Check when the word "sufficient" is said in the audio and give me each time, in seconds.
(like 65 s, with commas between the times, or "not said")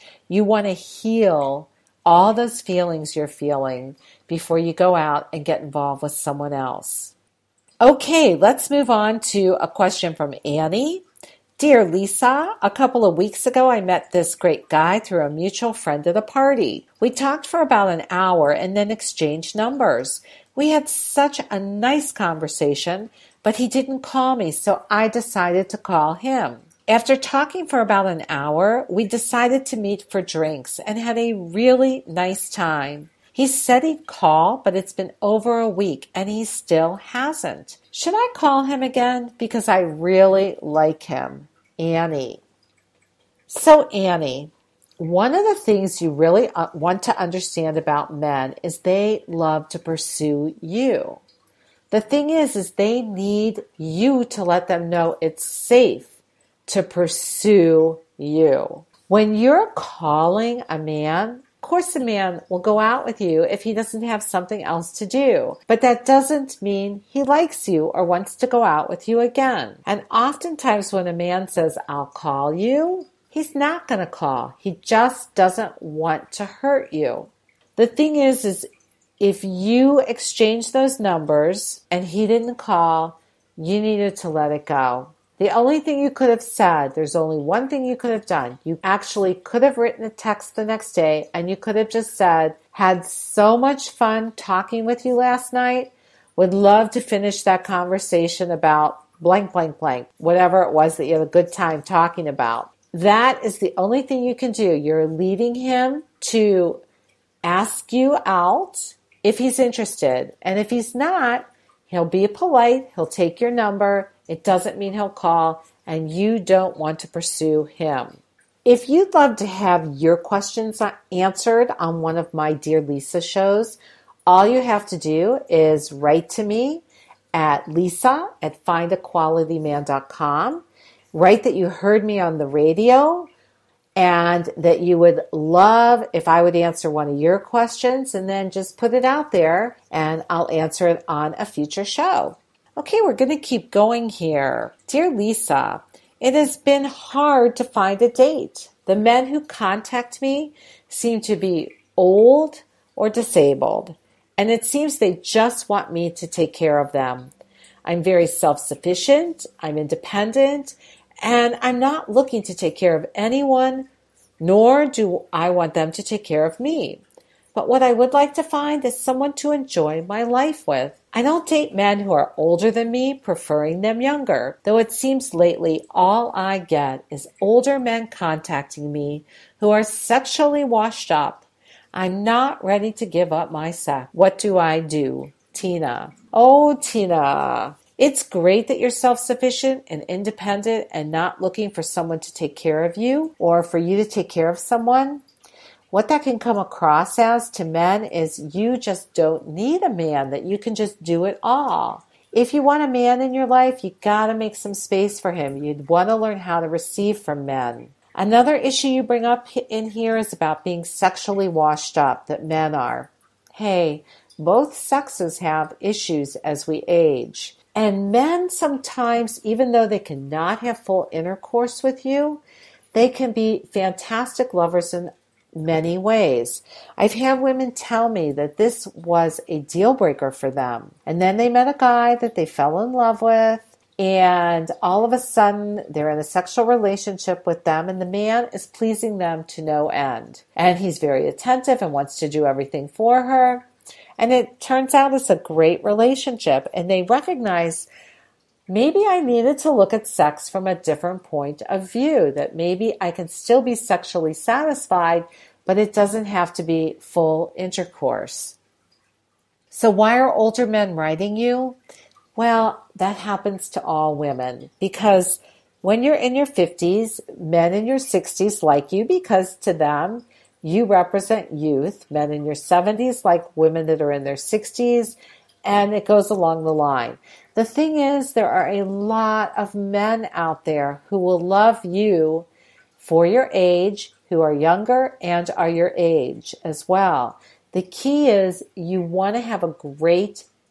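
158 s, 189 s.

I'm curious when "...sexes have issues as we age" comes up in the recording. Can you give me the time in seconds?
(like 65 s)
214 s.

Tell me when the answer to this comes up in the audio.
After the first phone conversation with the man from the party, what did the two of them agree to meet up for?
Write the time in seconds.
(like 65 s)
30 s.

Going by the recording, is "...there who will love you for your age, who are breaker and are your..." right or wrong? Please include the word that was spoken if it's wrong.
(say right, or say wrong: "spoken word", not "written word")
wrong: "younger", not "breaker".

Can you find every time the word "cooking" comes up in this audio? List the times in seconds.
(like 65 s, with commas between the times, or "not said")
not said.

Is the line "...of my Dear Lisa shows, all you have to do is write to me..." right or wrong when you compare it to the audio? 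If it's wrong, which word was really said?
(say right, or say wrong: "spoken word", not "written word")
right.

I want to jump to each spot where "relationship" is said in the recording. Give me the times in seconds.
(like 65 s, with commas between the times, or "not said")
236 s, 245 s.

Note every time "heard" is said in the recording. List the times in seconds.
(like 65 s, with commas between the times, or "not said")
131 s.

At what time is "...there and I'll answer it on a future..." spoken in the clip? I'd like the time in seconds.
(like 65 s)
139 s.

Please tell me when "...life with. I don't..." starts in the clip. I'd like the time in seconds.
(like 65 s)
170 s.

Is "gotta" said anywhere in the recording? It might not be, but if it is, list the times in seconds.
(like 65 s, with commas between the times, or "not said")
204 s.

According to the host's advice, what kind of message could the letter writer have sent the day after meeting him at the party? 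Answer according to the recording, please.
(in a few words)
a text.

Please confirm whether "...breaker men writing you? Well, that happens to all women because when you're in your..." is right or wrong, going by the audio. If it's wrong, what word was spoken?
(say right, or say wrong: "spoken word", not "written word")
wrong: "older", not "breaker".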